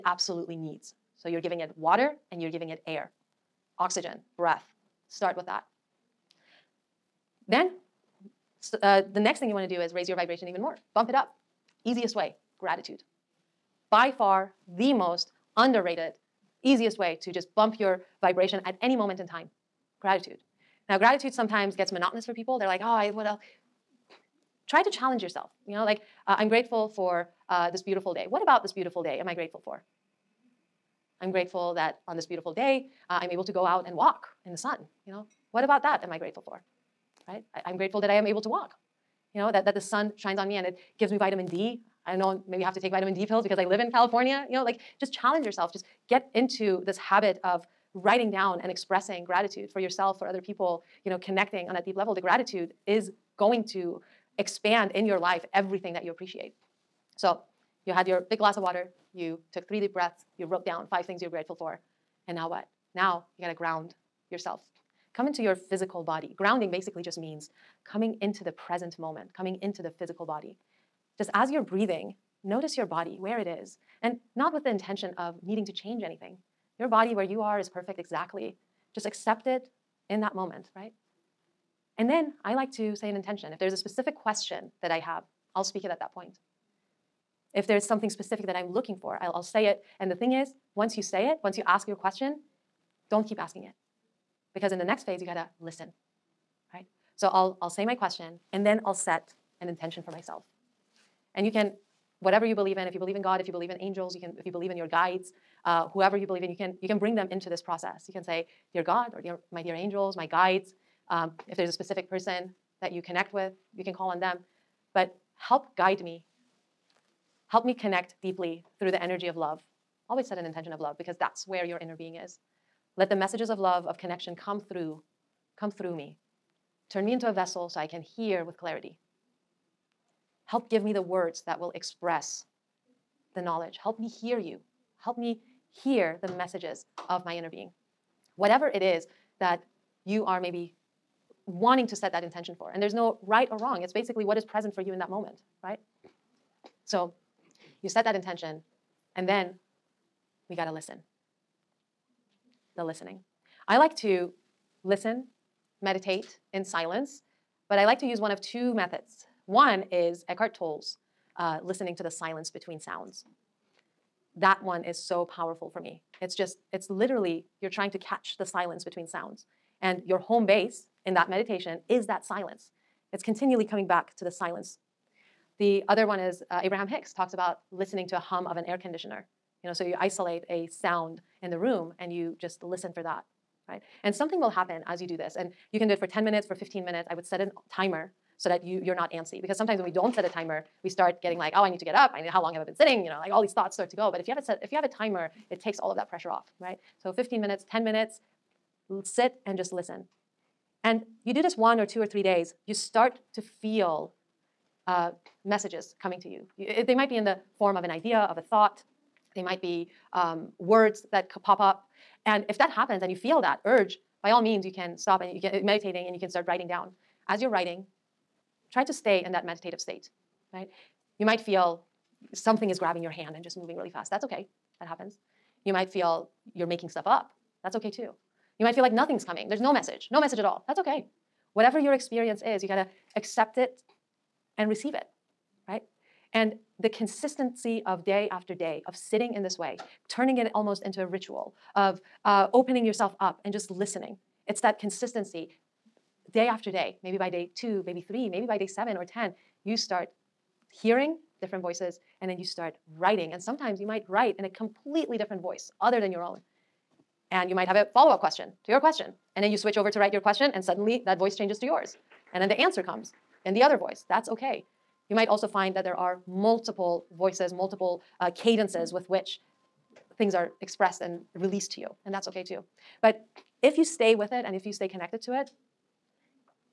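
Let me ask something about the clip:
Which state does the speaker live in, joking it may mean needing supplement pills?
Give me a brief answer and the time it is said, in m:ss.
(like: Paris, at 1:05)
California, at 0:43.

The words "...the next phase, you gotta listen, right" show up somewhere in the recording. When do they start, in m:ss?
1:34.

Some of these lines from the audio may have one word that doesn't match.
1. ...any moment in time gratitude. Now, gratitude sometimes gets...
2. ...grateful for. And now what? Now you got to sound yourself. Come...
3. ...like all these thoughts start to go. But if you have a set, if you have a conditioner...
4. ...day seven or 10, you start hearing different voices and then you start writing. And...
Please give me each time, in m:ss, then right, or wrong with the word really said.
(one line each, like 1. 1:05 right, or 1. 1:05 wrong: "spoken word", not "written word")
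1. 0:18 right
2. 1:01 wrong: "ground", not "sound"
3. 3:13 wrong: "timer", not "conditioner"
4. 4:08 right.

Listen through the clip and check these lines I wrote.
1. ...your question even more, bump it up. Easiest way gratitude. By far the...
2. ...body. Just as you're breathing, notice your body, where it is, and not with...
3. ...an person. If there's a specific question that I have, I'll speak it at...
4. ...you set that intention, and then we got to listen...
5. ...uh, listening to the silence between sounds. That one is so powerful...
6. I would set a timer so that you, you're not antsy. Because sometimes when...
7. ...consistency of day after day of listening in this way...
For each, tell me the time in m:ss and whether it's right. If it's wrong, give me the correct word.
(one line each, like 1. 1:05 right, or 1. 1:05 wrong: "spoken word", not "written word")
1. 0:10 wrong: "vibration", not "question"
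2. 1:10 right
3. 1:23 wrong: "intention", not "person"
4. 2:27 right
5. 2:41 right
6. 3:07 right
7. 3:56 wrong: "sitting", not "listening".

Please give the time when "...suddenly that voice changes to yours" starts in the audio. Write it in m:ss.
4:20.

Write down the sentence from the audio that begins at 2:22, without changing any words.
And there's no right or wrong.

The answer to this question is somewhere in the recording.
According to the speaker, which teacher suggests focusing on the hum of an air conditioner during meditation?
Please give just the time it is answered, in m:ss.
2:56.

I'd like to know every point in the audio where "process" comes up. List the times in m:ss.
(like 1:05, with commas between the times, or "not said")
1:47.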